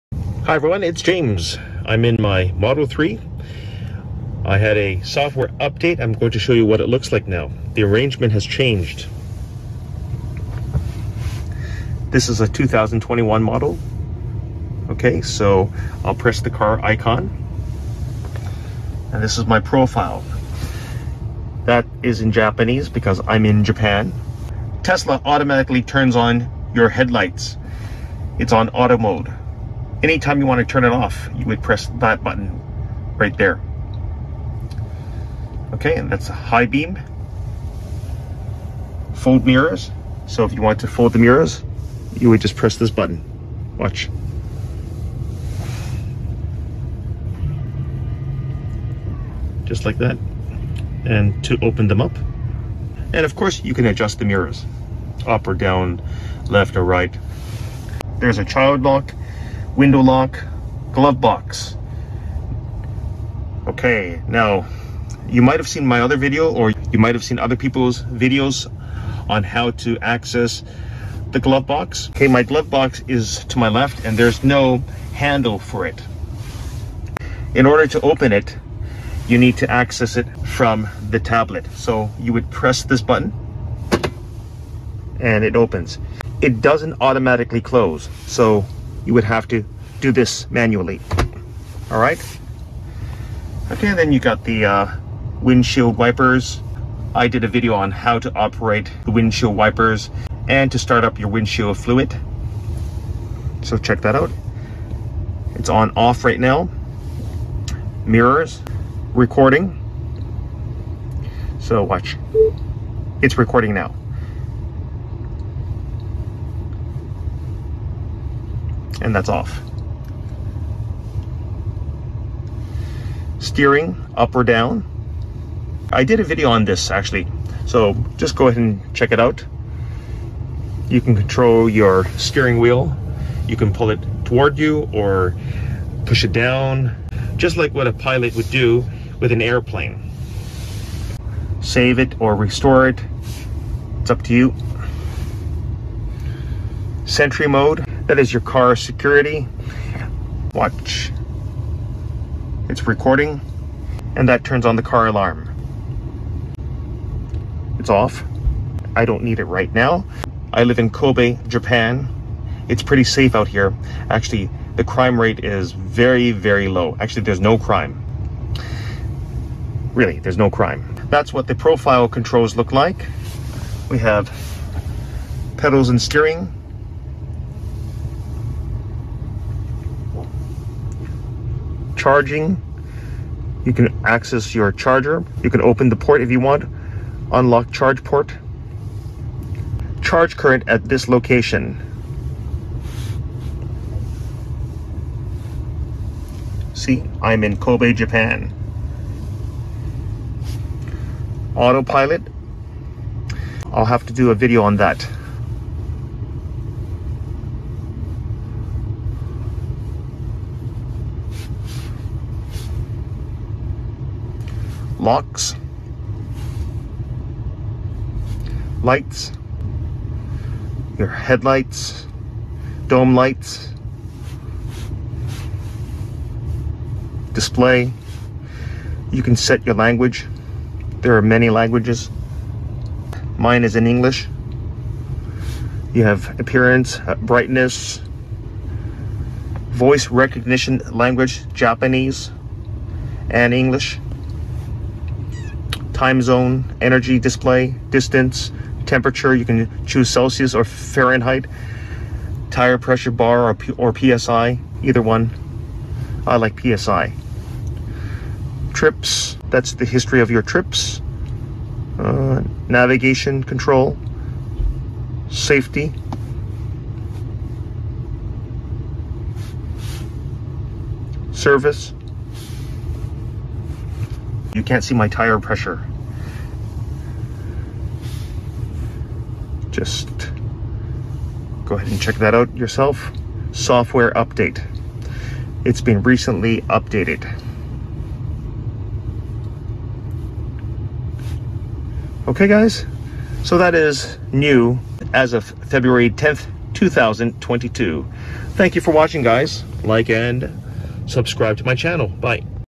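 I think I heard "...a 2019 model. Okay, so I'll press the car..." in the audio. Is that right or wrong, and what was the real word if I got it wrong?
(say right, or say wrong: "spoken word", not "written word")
wrong: "2021", not "2019".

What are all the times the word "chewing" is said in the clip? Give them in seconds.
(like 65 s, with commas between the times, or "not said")
not said.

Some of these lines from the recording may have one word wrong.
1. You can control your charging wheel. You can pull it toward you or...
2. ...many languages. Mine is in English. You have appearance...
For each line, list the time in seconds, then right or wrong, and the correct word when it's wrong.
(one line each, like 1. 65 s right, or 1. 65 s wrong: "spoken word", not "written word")
1. 130 s wrong: "steering", not "charging"
2. 231 s right.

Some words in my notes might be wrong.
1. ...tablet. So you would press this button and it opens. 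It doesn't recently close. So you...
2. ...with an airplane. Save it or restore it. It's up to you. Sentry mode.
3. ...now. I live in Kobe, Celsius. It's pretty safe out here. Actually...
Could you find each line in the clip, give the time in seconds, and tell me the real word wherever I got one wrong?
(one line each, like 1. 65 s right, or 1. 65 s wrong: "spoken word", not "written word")
1. 81 s wrong: "automatically", not "recently"
2. 139 s right
3. 159 s wrong: "Japan", not "Celsius".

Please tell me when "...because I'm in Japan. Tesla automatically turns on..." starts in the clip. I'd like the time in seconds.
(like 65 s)
22 s.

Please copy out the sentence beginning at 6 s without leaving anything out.
I'm going to show you what it looks like now.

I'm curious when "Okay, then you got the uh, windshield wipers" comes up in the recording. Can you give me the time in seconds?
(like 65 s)
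93 s.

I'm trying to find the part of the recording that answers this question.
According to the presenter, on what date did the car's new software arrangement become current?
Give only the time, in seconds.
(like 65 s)
295 s.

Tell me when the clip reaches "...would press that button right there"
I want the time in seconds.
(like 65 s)
31 s.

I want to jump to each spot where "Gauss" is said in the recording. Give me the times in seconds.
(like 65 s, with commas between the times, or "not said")
not said.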